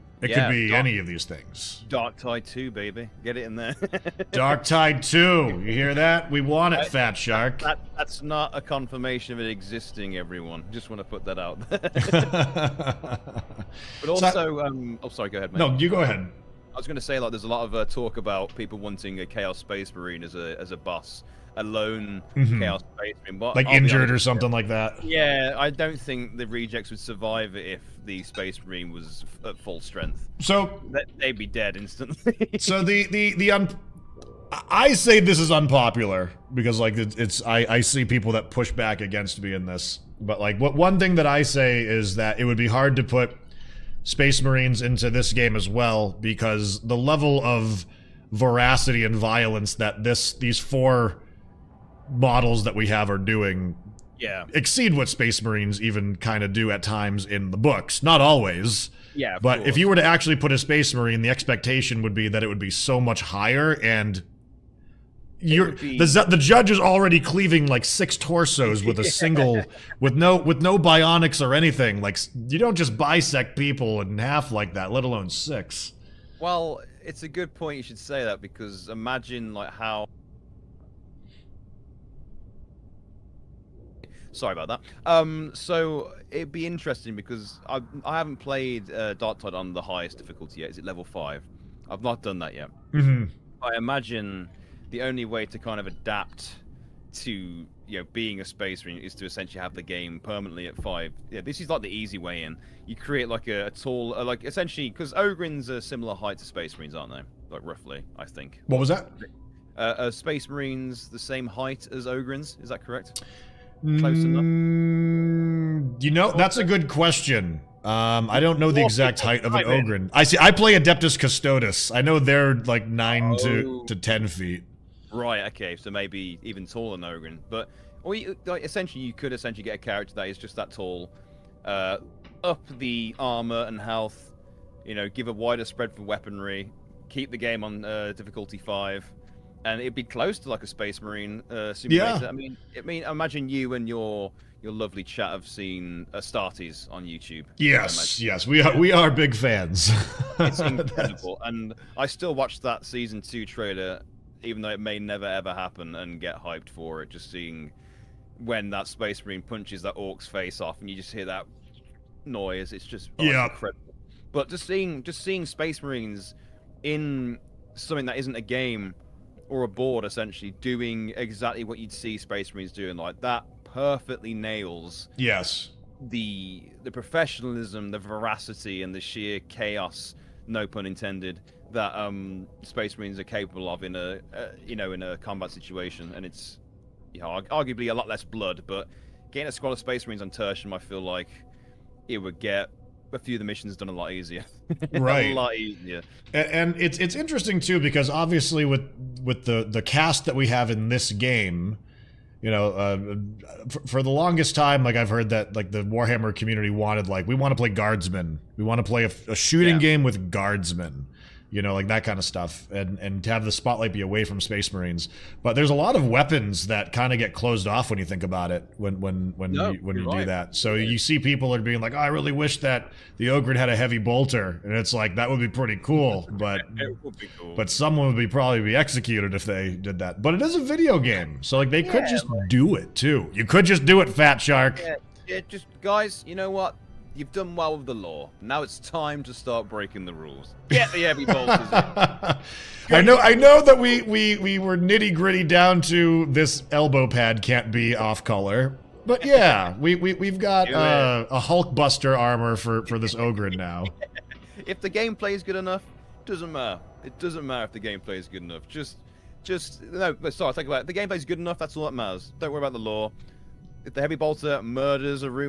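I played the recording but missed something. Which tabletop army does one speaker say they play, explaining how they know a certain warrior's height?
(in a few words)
Adeptus Custodes.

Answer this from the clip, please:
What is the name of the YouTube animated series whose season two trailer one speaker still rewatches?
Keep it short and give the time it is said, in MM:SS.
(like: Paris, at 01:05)
Astartes, at 02:26.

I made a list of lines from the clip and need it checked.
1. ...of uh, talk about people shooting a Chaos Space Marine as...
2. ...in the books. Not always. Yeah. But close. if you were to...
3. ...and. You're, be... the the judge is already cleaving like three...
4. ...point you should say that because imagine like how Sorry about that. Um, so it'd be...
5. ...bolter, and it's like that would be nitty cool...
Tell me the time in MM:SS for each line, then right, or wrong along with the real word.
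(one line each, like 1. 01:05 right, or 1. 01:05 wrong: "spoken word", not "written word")
1. 00:17 wrong: "wanting", not "shooting"
2. 00:57 wrong: "course", not "close"
3. 01:03 wrong: "six", not "three"
4. 01:17 right
5. 03:43 wrong: "pretty", not "nitty".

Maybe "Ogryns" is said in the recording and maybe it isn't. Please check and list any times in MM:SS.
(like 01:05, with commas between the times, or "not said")
01:45, 01:52, 01:59, 02:07.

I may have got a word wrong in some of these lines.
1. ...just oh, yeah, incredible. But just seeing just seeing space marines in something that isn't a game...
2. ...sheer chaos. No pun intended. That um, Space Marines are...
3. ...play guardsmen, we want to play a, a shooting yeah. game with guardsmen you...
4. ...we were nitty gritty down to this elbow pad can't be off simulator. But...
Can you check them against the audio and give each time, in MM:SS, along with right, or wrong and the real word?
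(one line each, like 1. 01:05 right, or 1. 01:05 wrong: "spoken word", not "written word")
1. 02:42 right
2. 02:59 right
3. 03:27 right
4. 04:04 wrong: "color", not "simulator".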